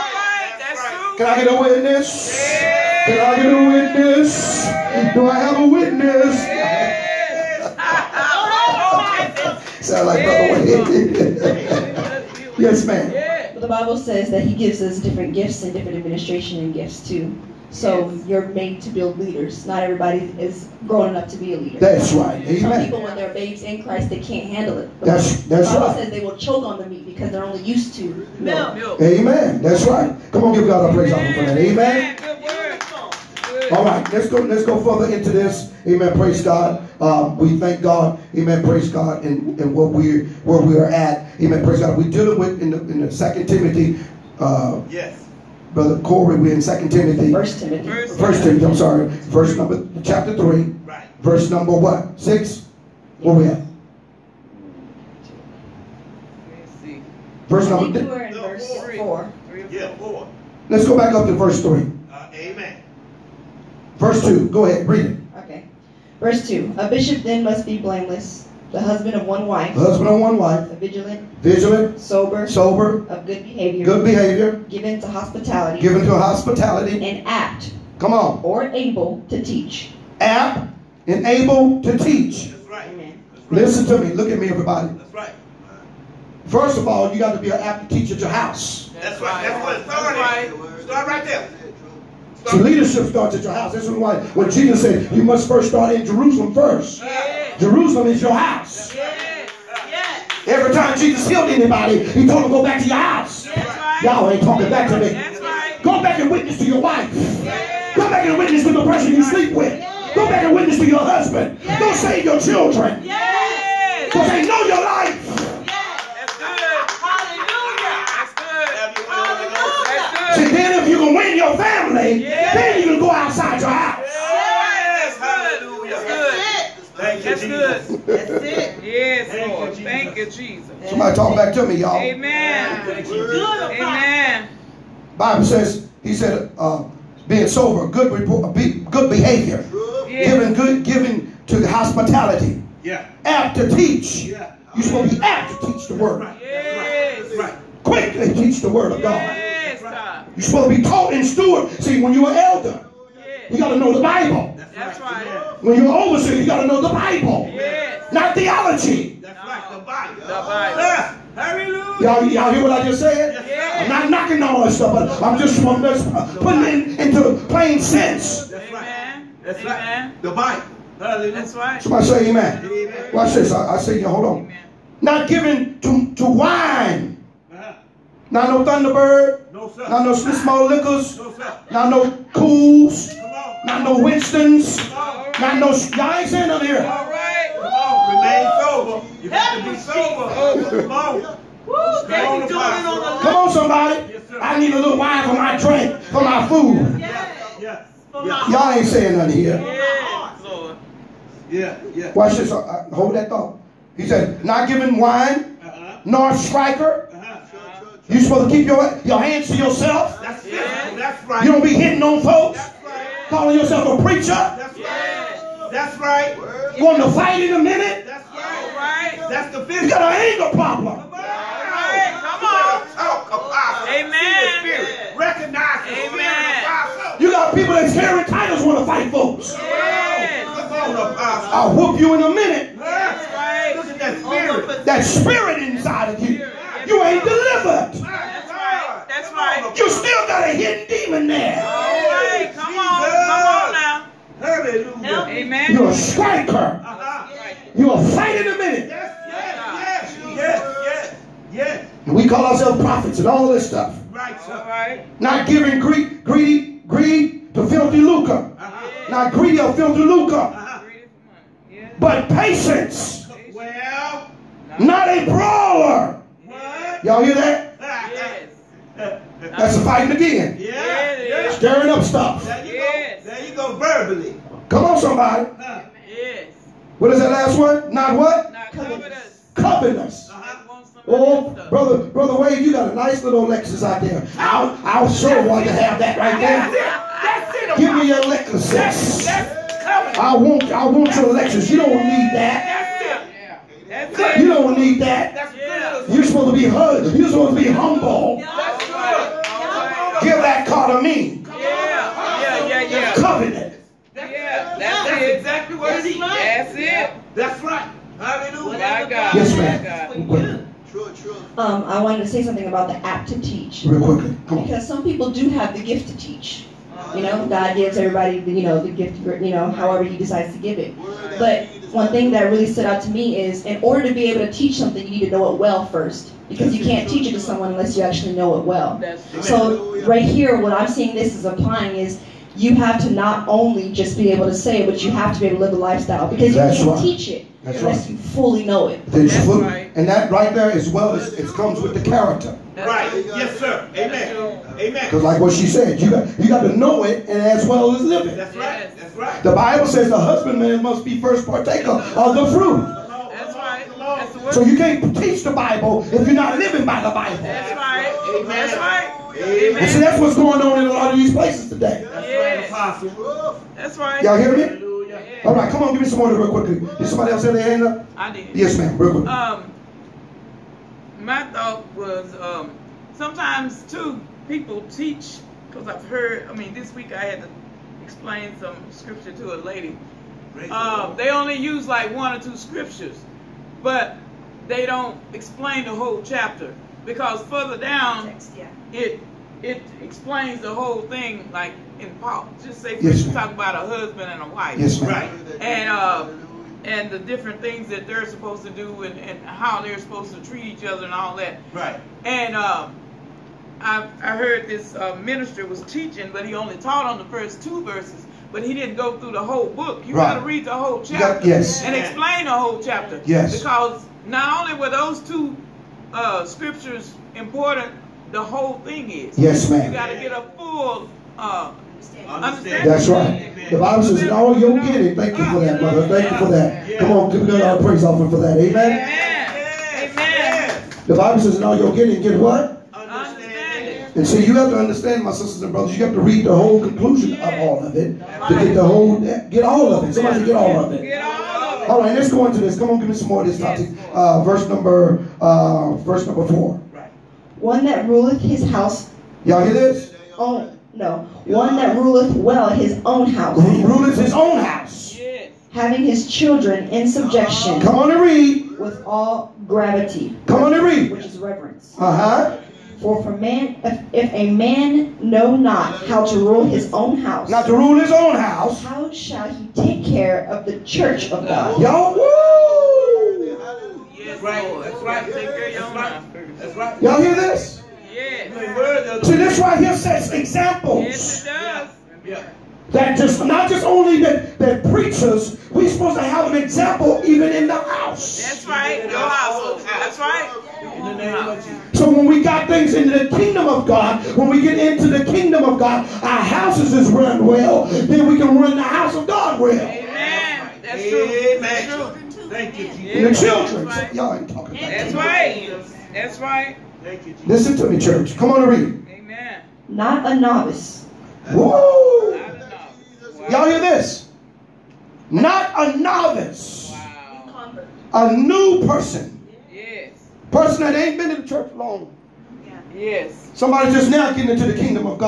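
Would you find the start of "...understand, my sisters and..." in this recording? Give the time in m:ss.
7:14.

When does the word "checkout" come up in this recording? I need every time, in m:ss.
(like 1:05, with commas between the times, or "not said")
not said.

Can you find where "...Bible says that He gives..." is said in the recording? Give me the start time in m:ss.
0:13.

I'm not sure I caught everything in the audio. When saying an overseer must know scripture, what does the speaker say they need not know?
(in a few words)
theology.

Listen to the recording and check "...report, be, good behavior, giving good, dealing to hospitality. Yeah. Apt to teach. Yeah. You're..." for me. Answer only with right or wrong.
wrong.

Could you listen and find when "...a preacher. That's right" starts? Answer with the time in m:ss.
3:33.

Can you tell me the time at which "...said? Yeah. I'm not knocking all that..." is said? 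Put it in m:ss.
2:43.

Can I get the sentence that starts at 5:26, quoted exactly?
Because you can't teach it to someone unless you actually know it well.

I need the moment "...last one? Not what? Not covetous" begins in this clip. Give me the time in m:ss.
4:37.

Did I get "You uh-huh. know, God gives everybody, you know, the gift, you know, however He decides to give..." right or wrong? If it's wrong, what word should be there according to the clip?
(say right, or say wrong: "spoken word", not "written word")
right.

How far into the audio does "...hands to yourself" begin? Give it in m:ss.
3:29.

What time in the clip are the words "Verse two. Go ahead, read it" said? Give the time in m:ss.
1:03.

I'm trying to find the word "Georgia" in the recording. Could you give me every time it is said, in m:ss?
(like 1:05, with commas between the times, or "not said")
not said.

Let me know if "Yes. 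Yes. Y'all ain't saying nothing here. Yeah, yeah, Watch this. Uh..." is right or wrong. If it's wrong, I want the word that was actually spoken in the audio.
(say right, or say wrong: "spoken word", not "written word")
right.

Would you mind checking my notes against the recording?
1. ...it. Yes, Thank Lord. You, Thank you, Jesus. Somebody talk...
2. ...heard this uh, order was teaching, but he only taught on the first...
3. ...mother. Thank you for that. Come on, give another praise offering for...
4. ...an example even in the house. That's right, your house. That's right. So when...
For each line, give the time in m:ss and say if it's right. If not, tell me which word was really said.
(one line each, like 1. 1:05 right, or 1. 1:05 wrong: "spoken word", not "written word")
1. 2:08 right
2. 6:44 wrong: "minister", not "order"
3. 7:05 right
4. 8:06 right.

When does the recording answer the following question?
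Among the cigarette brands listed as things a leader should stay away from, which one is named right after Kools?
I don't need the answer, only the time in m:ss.
3:03.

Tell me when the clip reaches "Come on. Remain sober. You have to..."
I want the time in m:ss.
3:07.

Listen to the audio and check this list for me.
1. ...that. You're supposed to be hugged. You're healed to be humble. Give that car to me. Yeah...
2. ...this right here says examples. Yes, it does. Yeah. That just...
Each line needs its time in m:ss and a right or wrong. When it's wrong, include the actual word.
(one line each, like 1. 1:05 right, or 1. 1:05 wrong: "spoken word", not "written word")
1. 4:55 wrong: "supposed", not "healed"
2. 7:59 right.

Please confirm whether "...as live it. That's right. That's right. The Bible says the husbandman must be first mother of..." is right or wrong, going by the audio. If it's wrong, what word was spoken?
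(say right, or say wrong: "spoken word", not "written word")
wrong: "partaker", not "mother".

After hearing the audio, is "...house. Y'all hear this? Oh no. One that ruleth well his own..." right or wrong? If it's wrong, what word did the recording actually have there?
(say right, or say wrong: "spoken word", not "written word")
right.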